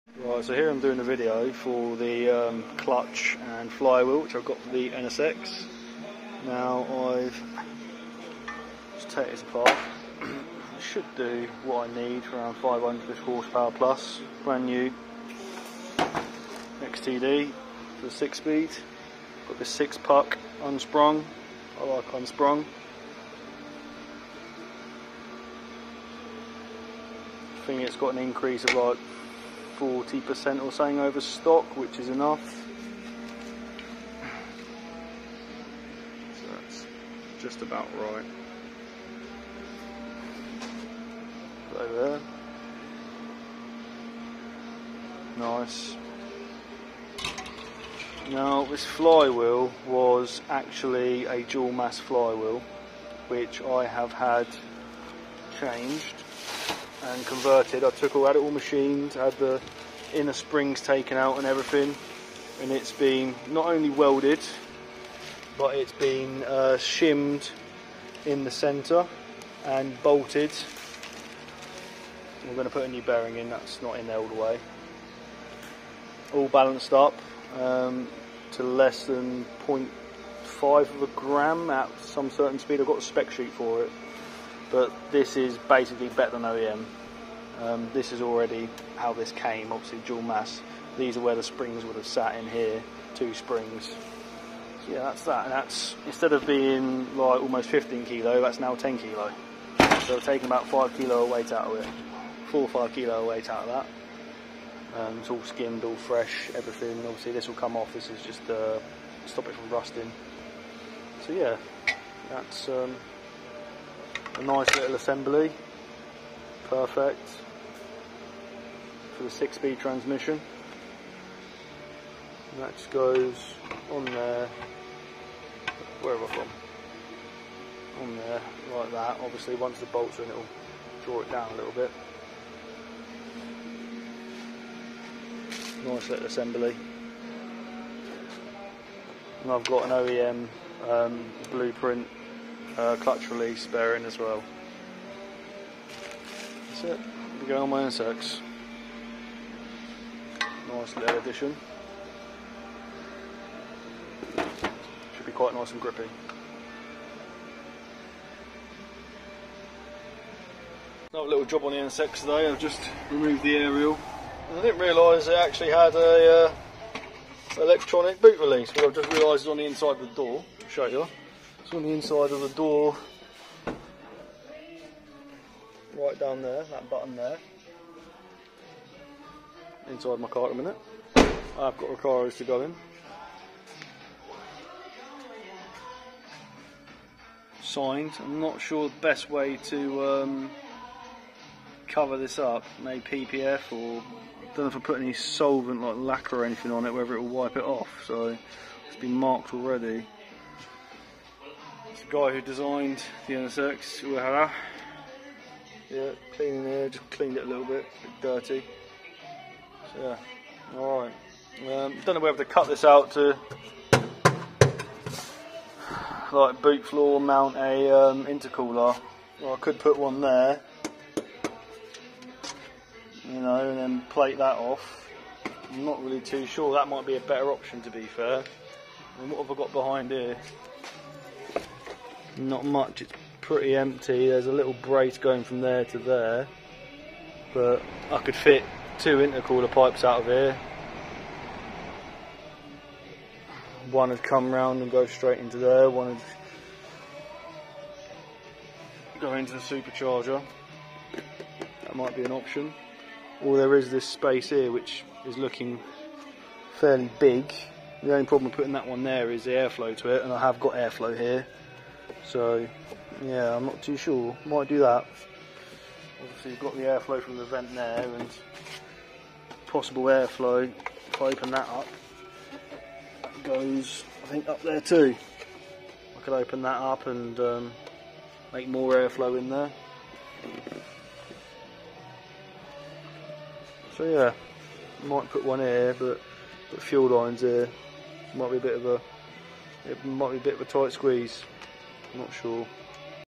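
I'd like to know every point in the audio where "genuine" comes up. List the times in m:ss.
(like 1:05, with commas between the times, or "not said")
not said.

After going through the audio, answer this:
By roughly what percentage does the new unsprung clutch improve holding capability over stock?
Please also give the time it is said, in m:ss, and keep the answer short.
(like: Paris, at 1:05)
40%, at 0:29.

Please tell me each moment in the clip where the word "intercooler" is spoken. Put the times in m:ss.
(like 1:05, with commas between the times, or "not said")
3:38, 3:59.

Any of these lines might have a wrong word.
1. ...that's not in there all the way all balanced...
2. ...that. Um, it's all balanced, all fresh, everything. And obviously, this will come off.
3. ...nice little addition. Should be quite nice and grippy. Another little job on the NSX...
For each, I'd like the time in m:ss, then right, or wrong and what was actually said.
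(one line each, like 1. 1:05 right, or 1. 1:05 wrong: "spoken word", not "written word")
1. 1:13 right
2. 1:43 wrong: "skimmed", not "balanced"
3. 2:30 right.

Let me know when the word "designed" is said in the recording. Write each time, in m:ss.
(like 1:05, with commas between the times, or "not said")
3:22.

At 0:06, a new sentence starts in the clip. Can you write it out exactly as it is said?
Now I've just taken this apart.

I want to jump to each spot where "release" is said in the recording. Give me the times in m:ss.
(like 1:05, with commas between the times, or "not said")
2:23, 2:48.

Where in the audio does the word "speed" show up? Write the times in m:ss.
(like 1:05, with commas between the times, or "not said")
0:18, 1:22, 1:59.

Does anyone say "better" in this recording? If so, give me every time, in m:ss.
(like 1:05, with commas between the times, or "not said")
1:26, 3:47.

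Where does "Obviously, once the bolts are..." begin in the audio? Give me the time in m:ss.
2:09.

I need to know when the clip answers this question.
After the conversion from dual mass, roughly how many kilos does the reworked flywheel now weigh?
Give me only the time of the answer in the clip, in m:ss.
1:38.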